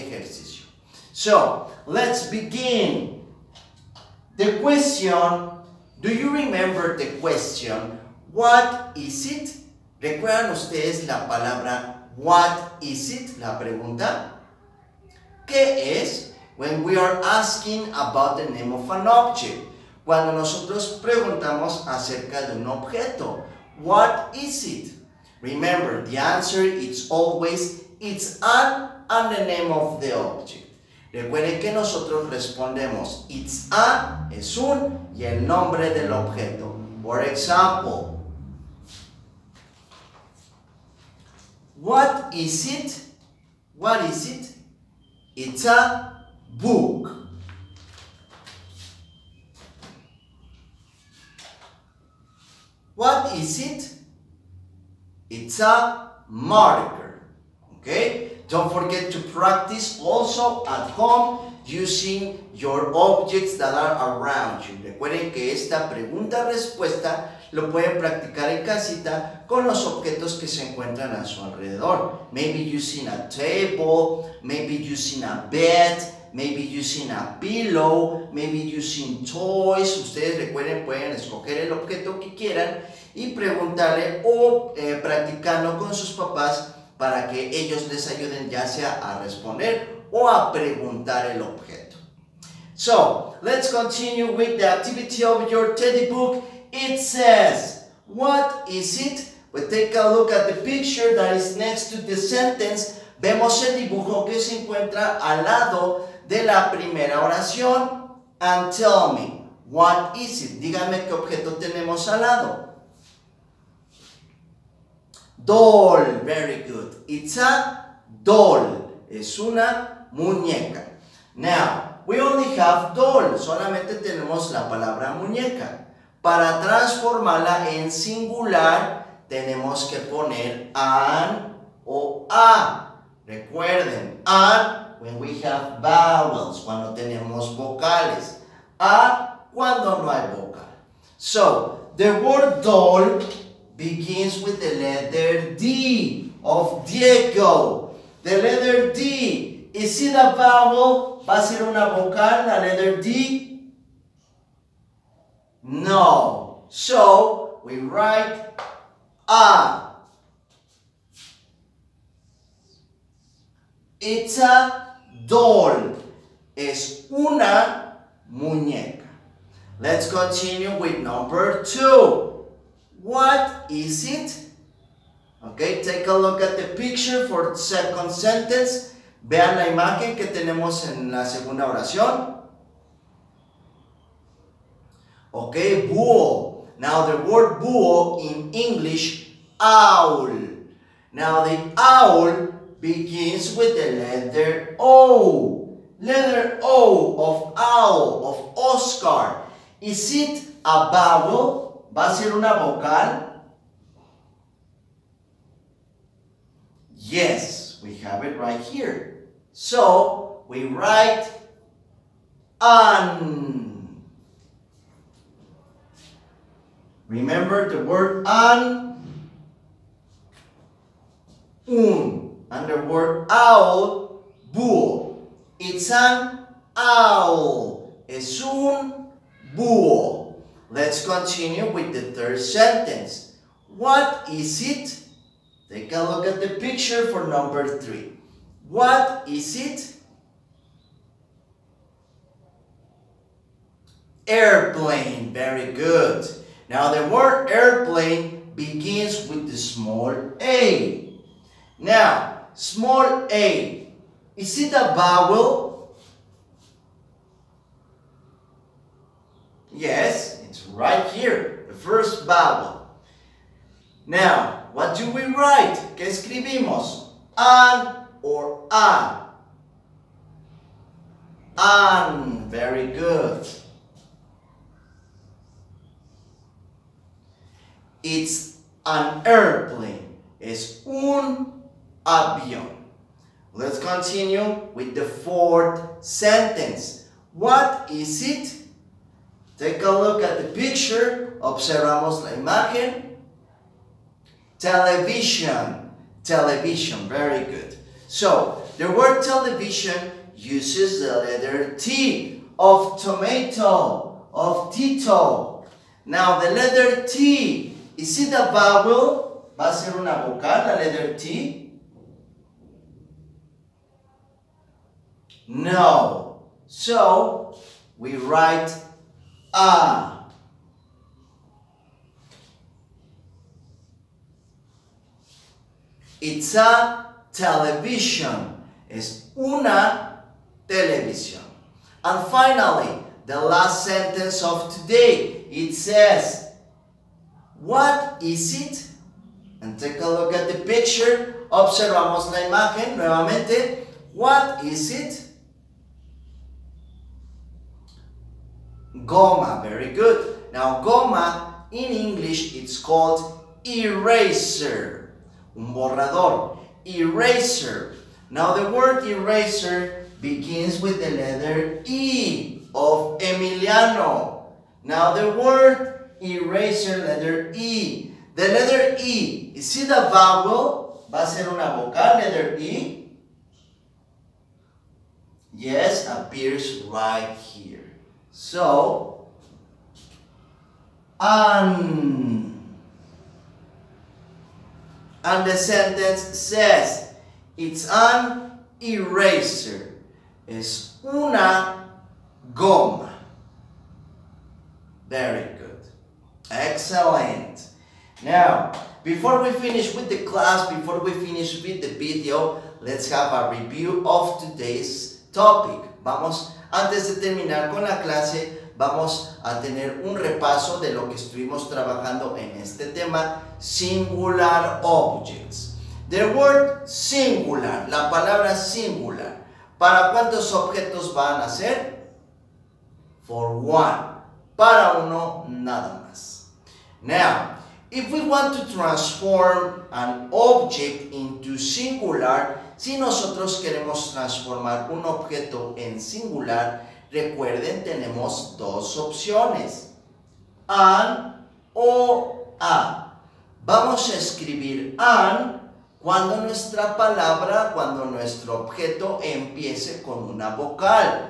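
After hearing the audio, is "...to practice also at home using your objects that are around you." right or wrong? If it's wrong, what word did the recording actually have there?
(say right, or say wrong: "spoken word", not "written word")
right.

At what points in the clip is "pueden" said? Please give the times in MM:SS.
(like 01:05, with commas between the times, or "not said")
01:07, 01:20.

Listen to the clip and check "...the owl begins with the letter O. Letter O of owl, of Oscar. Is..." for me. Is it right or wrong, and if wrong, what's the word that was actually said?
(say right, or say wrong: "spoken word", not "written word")
right.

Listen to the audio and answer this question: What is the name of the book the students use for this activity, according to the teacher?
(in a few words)
teddy book.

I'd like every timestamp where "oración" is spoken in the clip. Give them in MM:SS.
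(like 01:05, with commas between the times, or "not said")
01:47, 03:01.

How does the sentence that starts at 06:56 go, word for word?
The word singular, la palabra singular.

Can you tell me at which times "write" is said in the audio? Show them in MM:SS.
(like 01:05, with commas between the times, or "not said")
02:37, 03:30, 04:25, 05:18.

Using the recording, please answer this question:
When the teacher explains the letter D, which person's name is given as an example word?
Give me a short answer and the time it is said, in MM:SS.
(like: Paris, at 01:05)
Diego, at 02:26.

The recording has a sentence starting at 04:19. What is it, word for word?
Yes, it's right here, the first vowel.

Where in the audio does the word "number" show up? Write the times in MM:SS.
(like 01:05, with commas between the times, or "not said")
02:50, 03:57.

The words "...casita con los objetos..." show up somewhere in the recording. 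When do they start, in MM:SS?
01:08.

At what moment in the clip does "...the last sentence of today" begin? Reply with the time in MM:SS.
05:33.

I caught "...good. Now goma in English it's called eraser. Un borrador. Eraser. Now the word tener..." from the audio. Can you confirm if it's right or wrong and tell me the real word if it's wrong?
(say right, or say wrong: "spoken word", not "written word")
wrong: "eraser", not "tener".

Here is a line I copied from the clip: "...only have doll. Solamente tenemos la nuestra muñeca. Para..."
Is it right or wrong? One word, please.
wrong.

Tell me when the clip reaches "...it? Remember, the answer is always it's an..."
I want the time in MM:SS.
00:24.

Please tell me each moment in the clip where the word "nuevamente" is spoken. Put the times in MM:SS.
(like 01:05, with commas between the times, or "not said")
05:42.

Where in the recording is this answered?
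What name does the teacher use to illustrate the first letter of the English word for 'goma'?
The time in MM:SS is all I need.
06:03.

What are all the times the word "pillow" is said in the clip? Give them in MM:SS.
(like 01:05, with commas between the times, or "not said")
01:17.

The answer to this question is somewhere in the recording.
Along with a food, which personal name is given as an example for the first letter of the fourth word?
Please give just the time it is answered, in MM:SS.
05:04.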